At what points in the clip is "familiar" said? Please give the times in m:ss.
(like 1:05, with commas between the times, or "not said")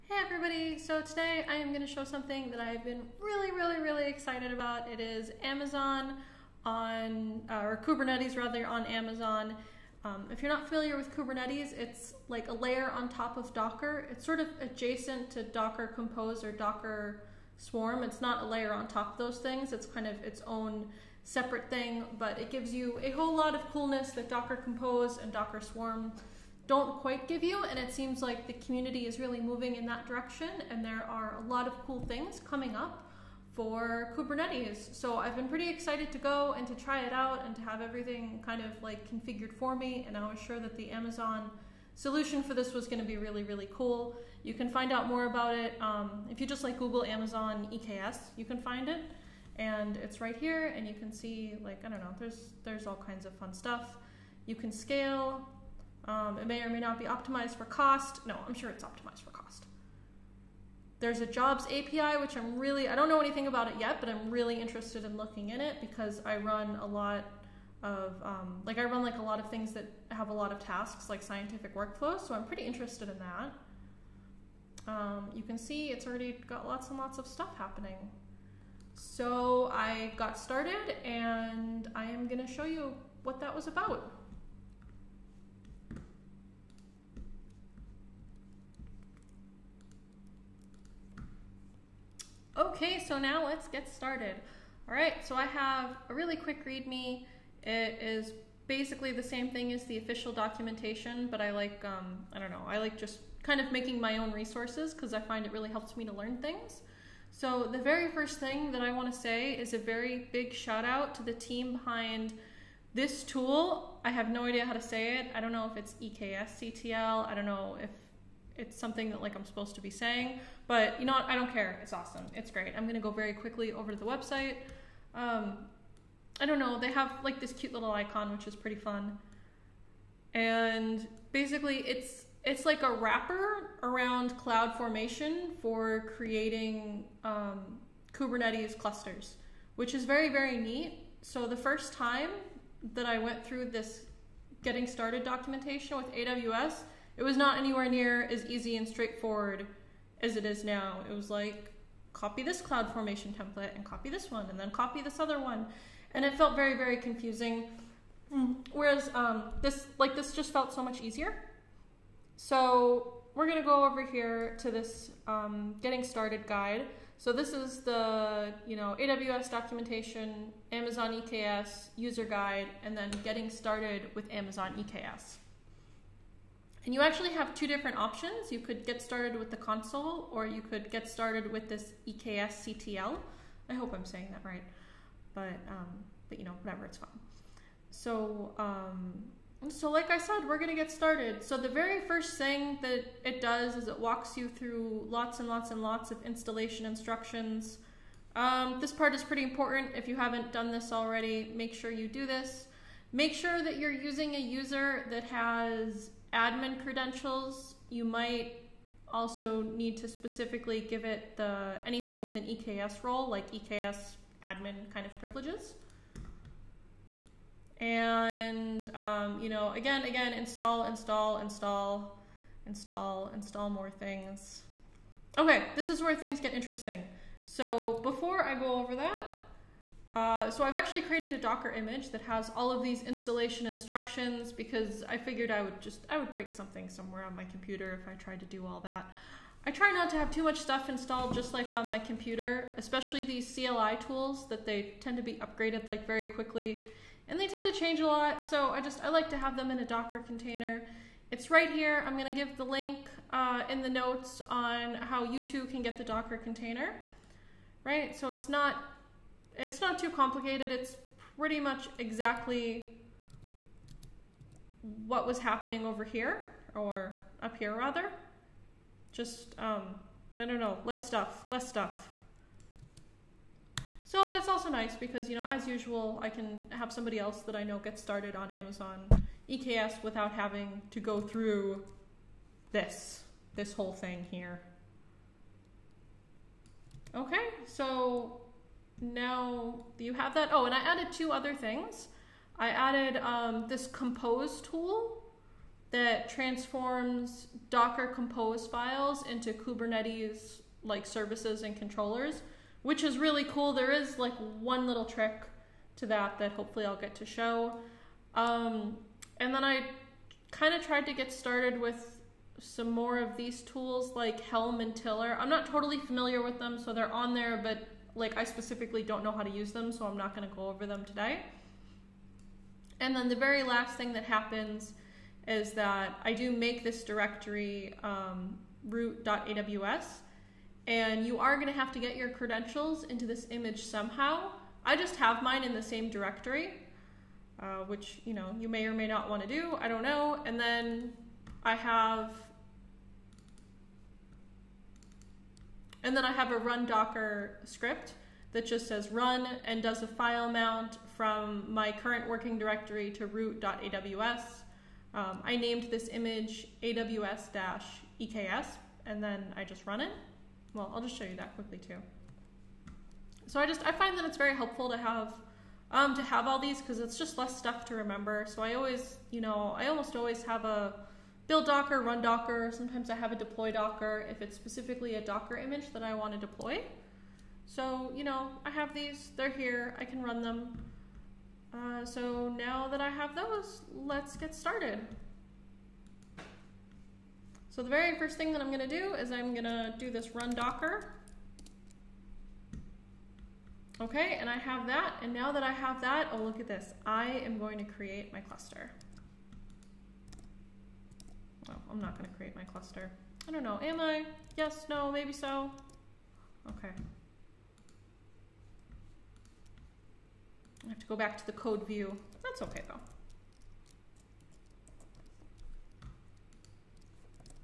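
0:10, 5:15.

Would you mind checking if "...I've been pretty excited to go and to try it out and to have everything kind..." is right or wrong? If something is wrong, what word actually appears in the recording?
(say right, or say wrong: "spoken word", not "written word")
right.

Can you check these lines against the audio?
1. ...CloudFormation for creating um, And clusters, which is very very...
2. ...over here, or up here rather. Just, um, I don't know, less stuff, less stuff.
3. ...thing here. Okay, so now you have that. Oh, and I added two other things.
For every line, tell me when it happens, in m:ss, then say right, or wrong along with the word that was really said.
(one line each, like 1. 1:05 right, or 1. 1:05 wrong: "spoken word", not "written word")
1. 2:14 wrong: "Kubernetes", not "And"
2. 4:25 right
3. 4:43 right.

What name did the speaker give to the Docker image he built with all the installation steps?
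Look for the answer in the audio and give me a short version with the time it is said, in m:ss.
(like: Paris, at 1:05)
aws-eks, at 5:56.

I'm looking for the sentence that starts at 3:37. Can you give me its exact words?
And um, you know, again, again, install, install, install, install, install more things.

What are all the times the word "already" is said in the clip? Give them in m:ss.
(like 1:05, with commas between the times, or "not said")
1:16, 3:20.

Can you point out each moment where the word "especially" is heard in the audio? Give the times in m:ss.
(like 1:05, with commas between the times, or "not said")
4:02.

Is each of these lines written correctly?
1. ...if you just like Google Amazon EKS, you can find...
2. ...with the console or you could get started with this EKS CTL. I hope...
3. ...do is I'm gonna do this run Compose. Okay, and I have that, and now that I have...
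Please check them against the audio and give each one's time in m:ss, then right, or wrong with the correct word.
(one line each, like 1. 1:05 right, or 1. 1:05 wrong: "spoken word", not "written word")
1. 0:46 right
2. 2:59 right
3. 6:28 wrong: "Docker", not "Compose".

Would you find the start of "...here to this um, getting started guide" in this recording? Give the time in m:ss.
2:44.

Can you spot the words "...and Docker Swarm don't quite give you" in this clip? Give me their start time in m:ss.
0:25.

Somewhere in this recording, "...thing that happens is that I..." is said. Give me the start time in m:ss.
5:23.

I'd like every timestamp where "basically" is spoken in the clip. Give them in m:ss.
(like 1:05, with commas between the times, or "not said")
1:38, 2:11.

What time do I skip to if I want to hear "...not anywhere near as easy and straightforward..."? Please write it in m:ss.
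2:27.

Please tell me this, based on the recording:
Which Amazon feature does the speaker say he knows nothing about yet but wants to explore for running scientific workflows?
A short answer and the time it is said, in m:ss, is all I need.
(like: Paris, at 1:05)
jobs API, at 1:01.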